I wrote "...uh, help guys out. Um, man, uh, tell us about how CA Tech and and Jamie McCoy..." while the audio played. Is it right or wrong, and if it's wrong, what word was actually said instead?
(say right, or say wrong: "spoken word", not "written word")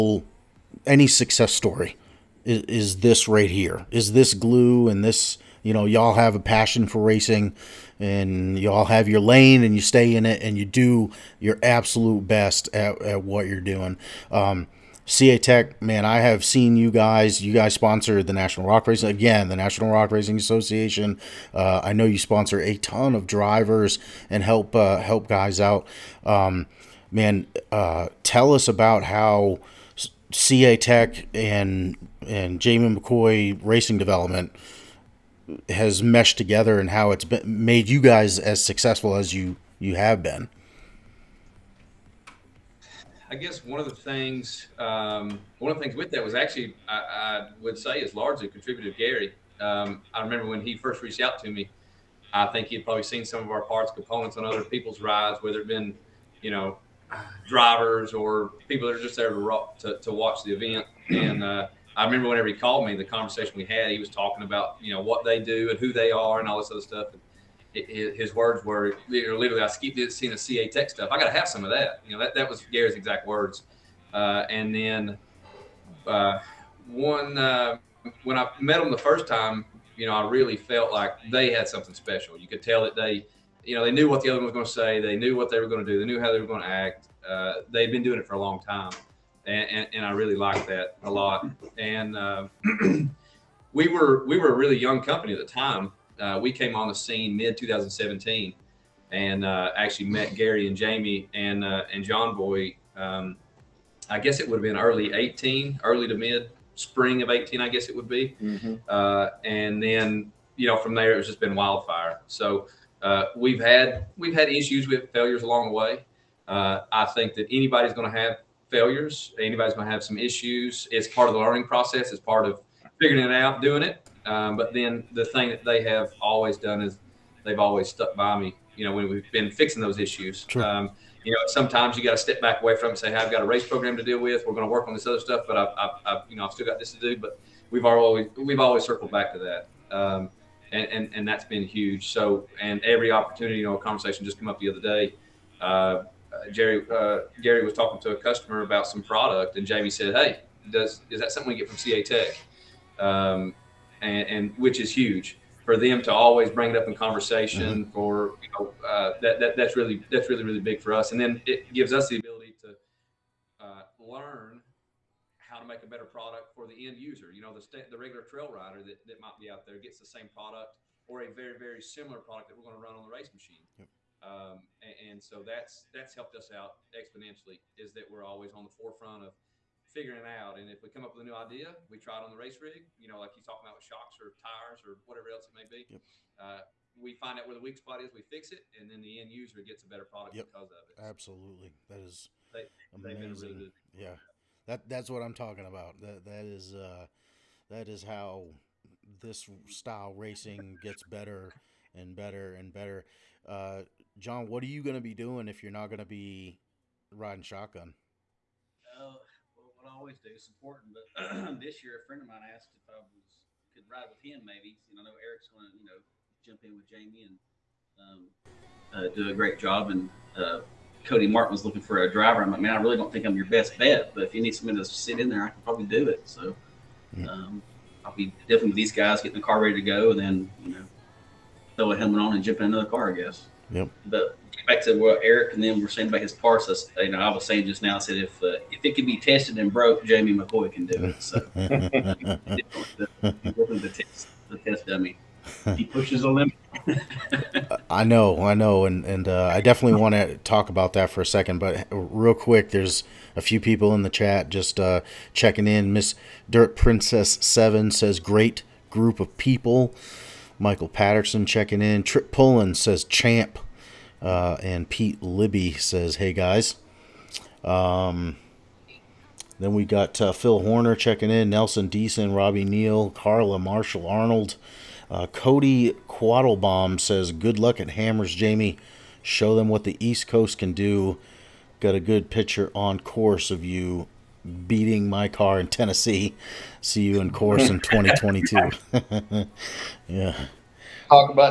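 right.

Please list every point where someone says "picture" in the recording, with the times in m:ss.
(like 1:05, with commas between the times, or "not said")
4:42.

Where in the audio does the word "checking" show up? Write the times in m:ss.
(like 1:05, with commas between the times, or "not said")
4:15, 4:21, 4:30.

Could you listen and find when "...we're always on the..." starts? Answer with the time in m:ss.
2:58.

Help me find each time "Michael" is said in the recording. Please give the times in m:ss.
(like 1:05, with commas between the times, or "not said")
4:20.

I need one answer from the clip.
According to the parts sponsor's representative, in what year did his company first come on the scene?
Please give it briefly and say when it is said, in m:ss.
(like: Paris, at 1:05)
2017, at 1:37.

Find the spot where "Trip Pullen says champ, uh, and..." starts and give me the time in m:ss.
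4:22.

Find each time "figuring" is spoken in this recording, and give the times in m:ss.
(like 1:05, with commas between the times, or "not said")
2:03, 2:59.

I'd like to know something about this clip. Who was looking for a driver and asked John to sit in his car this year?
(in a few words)
Cody Martin.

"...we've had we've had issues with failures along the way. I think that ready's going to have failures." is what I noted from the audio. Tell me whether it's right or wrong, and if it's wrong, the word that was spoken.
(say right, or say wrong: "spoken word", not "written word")
wrong: "anybody", not "ready".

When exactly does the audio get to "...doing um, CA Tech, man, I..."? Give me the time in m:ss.
0:13.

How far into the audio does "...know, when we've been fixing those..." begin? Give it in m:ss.
2:08.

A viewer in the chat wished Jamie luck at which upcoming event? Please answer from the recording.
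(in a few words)
Hammers.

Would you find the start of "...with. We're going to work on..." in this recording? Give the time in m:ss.
2:14.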